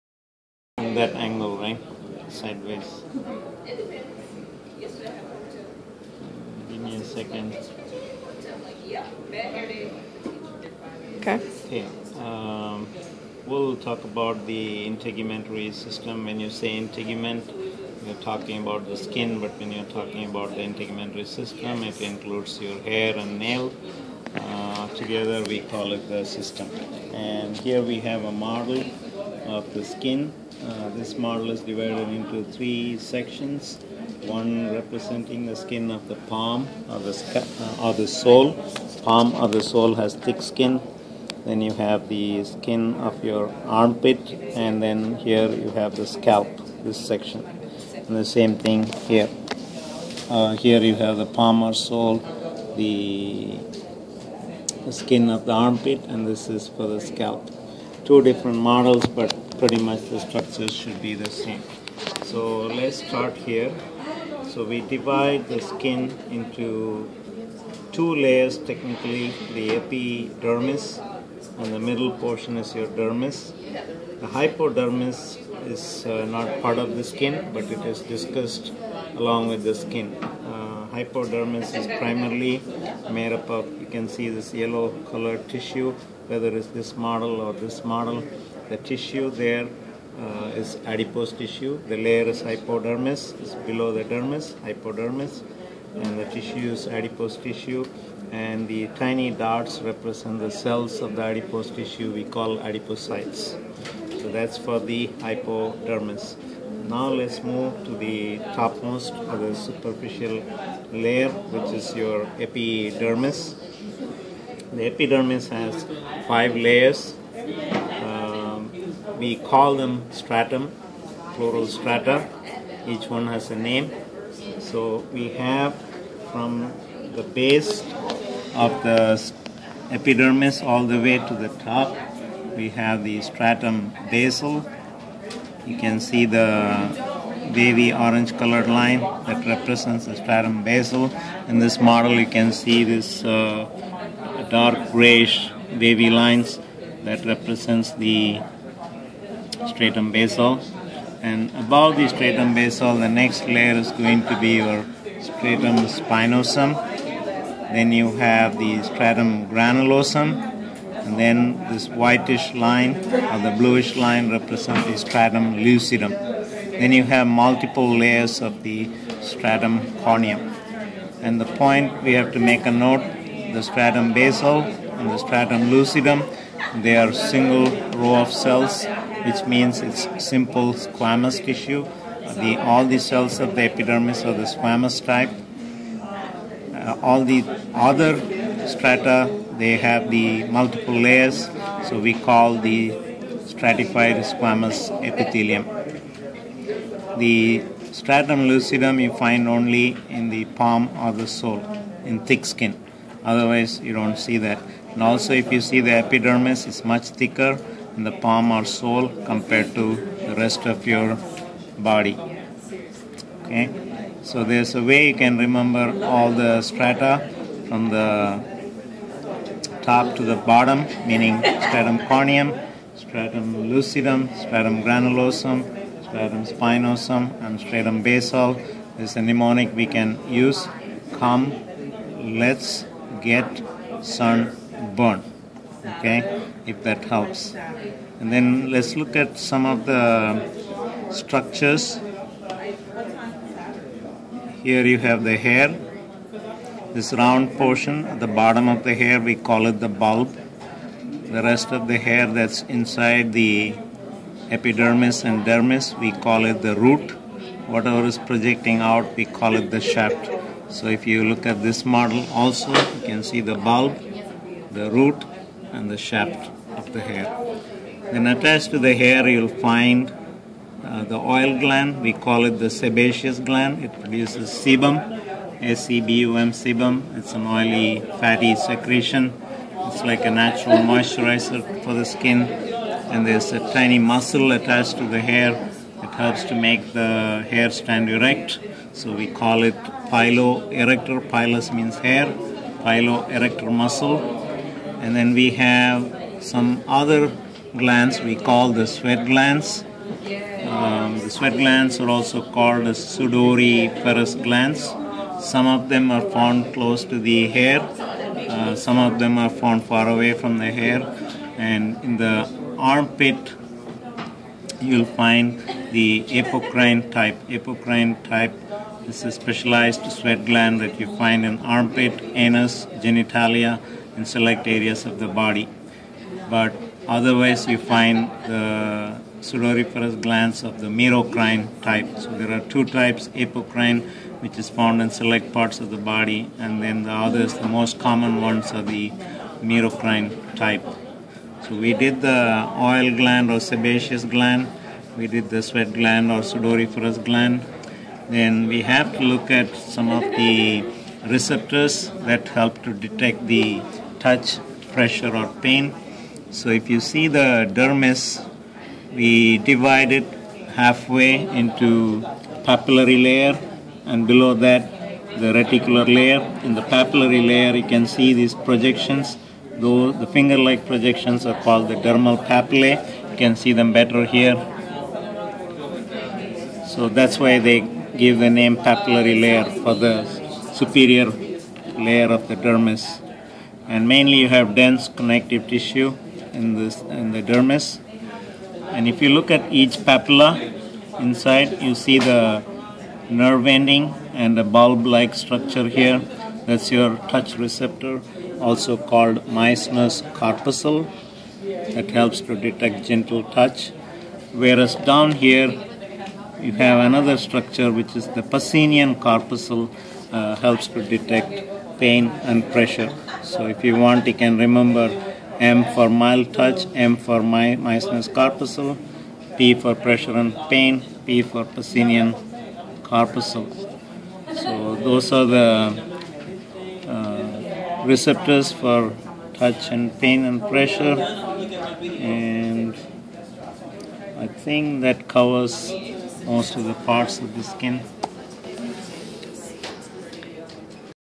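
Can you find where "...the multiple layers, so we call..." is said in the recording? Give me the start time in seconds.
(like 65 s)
190 s.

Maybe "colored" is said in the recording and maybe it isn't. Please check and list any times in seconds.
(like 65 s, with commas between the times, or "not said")
85 s, 138 s.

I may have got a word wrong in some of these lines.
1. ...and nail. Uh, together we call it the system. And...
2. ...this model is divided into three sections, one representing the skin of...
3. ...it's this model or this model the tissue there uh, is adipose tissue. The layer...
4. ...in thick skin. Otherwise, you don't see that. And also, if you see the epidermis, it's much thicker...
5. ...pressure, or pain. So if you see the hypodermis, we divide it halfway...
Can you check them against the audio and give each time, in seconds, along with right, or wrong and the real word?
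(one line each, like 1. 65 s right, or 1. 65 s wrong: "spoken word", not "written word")
1. 23 s right
2. 30 s right
3. 86 s right
4. 202 s right
5. 354 s wrong: "dermis", not "hypodermis".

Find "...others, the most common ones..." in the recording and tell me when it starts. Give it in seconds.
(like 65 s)
337 s.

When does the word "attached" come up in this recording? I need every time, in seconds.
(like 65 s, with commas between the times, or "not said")
268 s, 284 s.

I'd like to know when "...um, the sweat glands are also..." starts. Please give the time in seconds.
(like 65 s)
300 s.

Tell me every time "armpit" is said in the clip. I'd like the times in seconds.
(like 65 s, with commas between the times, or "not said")
43 s, 55 s, 312 s, 321 s.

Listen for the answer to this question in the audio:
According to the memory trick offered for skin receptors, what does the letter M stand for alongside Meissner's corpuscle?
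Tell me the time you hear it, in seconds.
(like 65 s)
416 s.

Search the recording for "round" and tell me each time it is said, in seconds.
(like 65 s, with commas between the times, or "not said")
247 s.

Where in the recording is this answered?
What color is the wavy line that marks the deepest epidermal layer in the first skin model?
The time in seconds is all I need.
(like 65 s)
137 s.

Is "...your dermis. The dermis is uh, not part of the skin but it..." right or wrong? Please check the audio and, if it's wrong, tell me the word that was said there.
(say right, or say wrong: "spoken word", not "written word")
wrong: "hypodermis", not "dermis".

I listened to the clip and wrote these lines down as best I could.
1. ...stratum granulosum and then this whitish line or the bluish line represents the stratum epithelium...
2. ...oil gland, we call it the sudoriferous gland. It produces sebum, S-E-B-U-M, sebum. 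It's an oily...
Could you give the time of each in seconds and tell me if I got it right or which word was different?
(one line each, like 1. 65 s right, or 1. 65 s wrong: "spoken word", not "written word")
1. 158 s wrong: "lucidum", not "epithelium"
2. 271 s wrong: "sebaceous", not "sudoriferous".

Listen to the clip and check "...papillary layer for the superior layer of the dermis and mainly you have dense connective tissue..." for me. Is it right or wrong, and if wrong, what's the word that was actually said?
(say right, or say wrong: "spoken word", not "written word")
right.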